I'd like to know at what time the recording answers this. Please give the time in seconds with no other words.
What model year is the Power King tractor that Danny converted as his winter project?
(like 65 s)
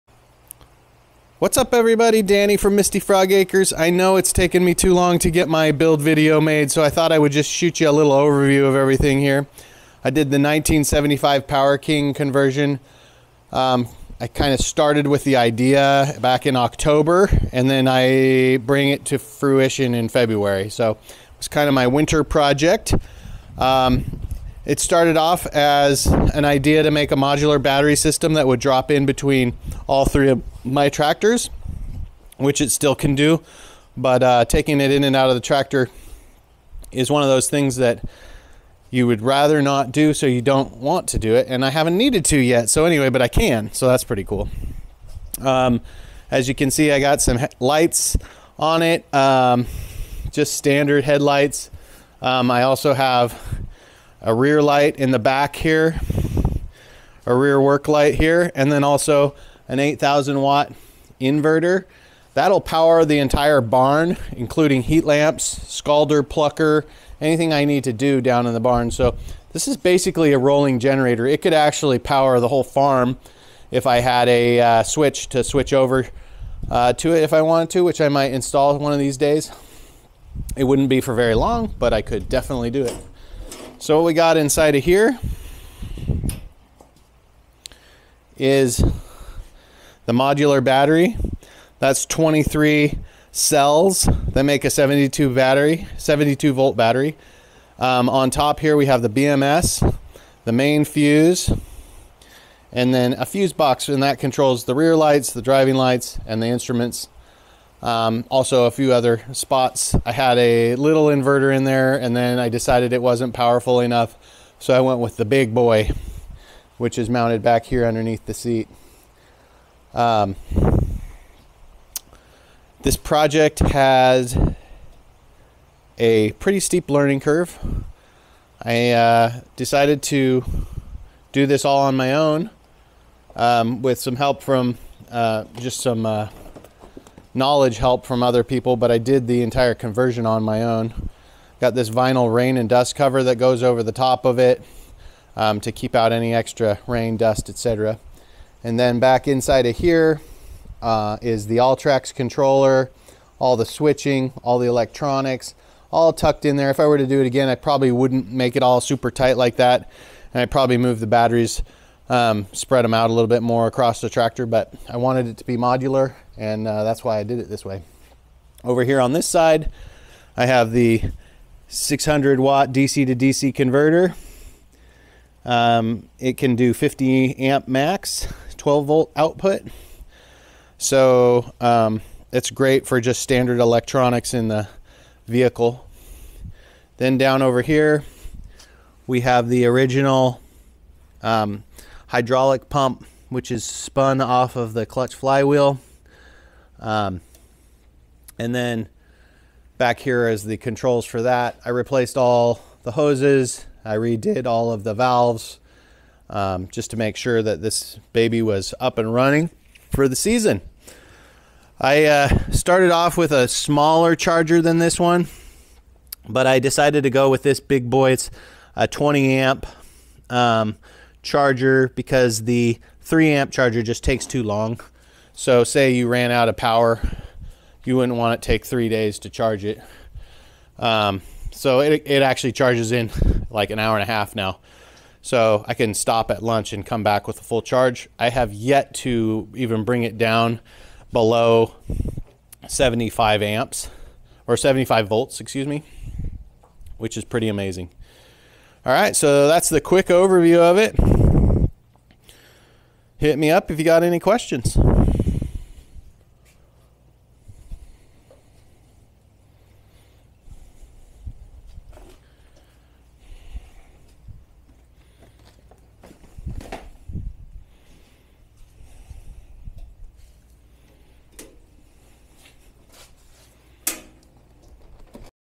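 10 s.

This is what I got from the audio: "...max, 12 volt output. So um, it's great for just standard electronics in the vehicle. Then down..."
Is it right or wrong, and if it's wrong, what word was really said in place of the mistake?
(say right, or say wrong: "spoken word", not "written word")
right.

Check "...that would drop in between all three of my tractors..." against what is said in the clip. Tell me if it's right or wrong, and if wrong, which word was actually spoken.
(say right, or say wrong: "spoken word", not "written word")
right.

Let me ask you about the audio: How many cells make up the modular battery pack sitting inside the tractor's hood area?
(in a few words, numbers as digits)
23.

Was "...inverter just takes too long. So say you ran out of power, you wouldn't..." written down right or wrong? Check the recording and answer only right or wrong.
wrong.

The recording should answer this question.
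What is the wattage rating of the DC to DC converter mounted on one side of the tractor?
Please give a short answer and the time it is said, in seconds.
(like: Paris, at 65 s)
600 watt, at 171 s.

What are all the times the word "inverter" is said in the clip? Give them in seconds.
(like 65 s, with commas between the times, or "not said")
61 s, 111 s.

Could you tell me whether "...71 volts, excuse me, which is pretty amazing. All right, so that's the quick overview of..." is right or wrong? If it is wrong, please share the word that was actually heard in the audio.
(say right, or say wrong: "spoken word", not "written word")
wrong: "75", not "71".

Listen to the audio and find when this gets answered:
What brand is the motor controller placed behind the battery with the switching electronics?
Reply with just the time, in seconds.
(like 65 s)
151 s.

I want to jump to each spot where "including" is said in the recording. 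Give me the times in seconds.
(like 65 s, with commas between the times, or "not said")
64 s.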